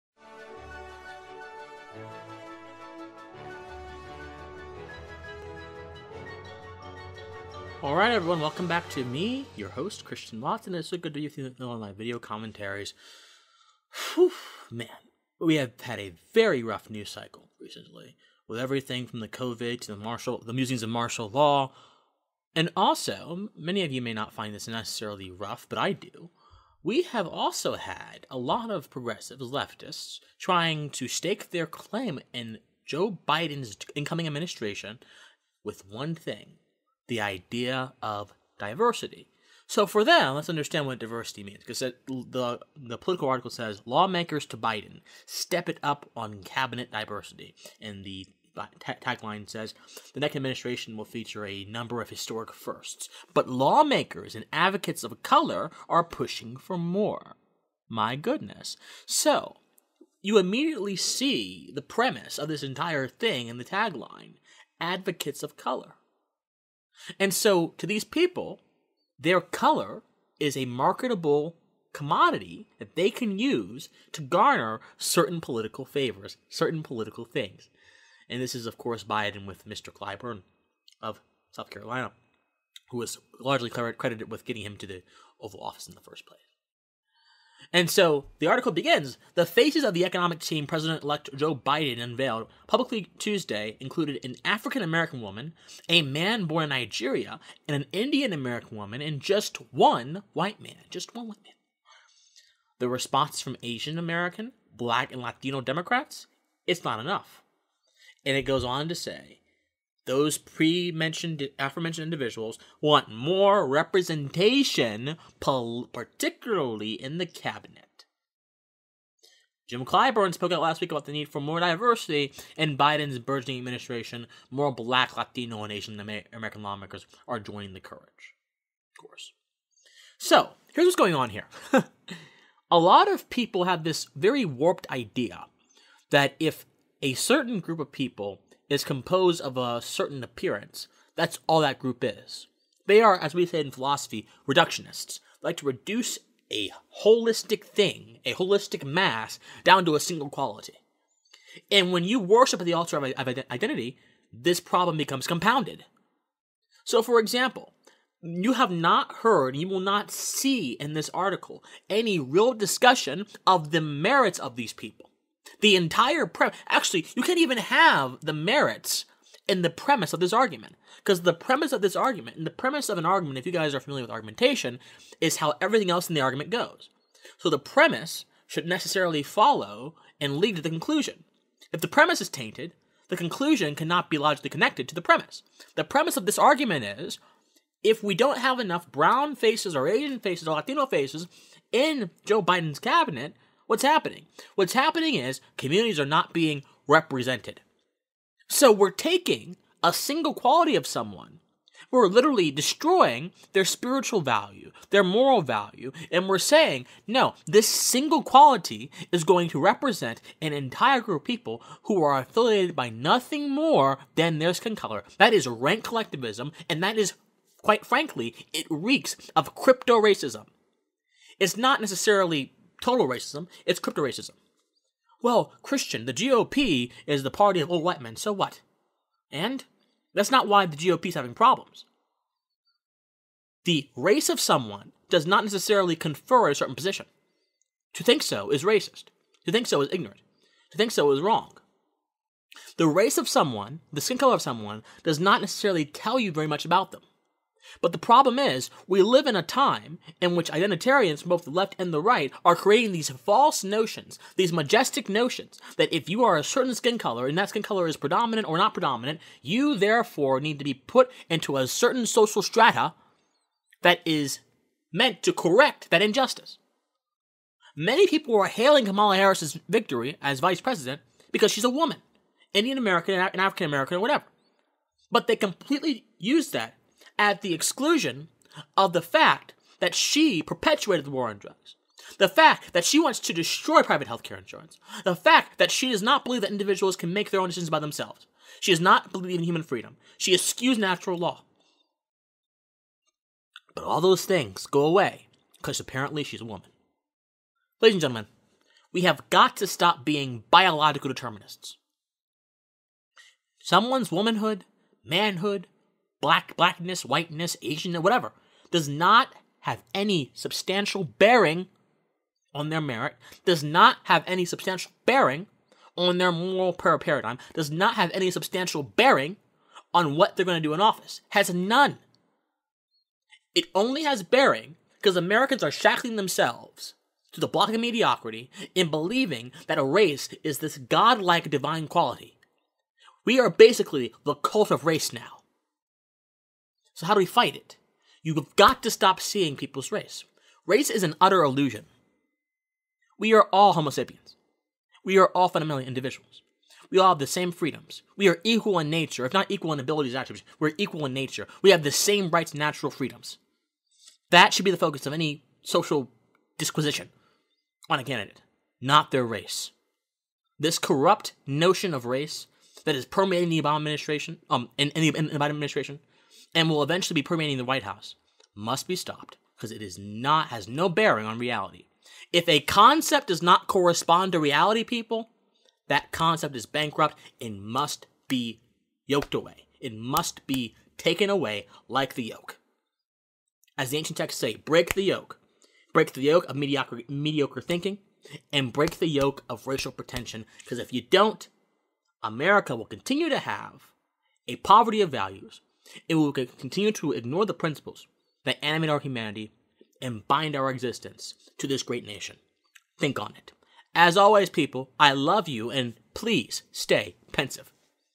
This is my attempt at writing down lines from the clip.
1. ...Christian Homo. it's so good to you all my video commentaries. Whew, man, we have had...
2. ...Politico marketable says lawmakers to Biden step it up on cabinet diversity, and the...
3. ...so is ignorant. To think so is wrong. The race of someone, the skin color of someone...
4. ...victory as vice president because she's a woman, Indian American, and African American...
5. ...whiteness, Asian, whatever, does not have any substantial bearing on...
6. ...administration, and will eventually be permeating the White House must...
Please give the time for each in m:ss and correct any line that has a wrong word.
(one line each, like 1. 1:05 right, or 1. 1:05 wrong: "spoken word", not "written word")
1. 0:10 wrong: "Watson", not "Homo"
2. 0:42 wrong: "article", not "marketable"
3. 3:59 right
4. 4:29 right
5. 5:07 right
6. 6:05 right.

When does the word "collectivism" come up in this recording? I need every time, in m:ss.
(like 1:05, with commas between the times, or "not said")
3:35.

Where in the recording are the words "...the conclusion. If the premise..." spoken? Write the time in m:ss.
3:00.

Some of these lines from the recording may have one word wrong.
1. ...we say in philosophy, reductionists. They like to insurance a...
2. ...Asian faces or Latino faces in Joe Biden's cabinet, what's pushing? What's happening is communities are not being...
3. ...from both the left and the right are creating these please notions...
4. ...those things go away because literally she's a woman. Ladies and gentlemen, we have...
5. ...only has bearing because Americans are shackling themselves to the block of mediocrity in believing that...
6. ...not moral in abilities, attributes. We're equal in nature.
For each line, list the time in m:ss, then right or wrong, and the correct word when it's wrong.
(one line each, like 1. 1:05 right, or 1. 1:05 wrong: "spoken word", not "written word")
1. 2:23 wrong: "reduce", not "insurance"
2. 3:09 wrong: "happening", not "pushing"
3. 4:11 wrong: "false", not "please"
4. 4:54 wrong: "apparently", not "literally"
5. 5:23 right
6. 5:49 wrong: "equal", not "moral".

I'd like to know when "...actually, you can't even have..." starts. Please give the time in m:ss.
2:46.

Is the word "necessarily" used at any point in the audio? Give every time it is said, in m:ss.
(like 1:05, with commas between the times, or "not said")
0:24, 2:58, 3:41, 3:55, 4:05.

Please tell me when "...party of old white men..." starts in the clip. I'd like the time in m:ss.
3:47.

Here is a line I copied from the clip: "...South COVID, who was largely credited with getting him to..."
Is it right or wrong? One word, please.
wrong.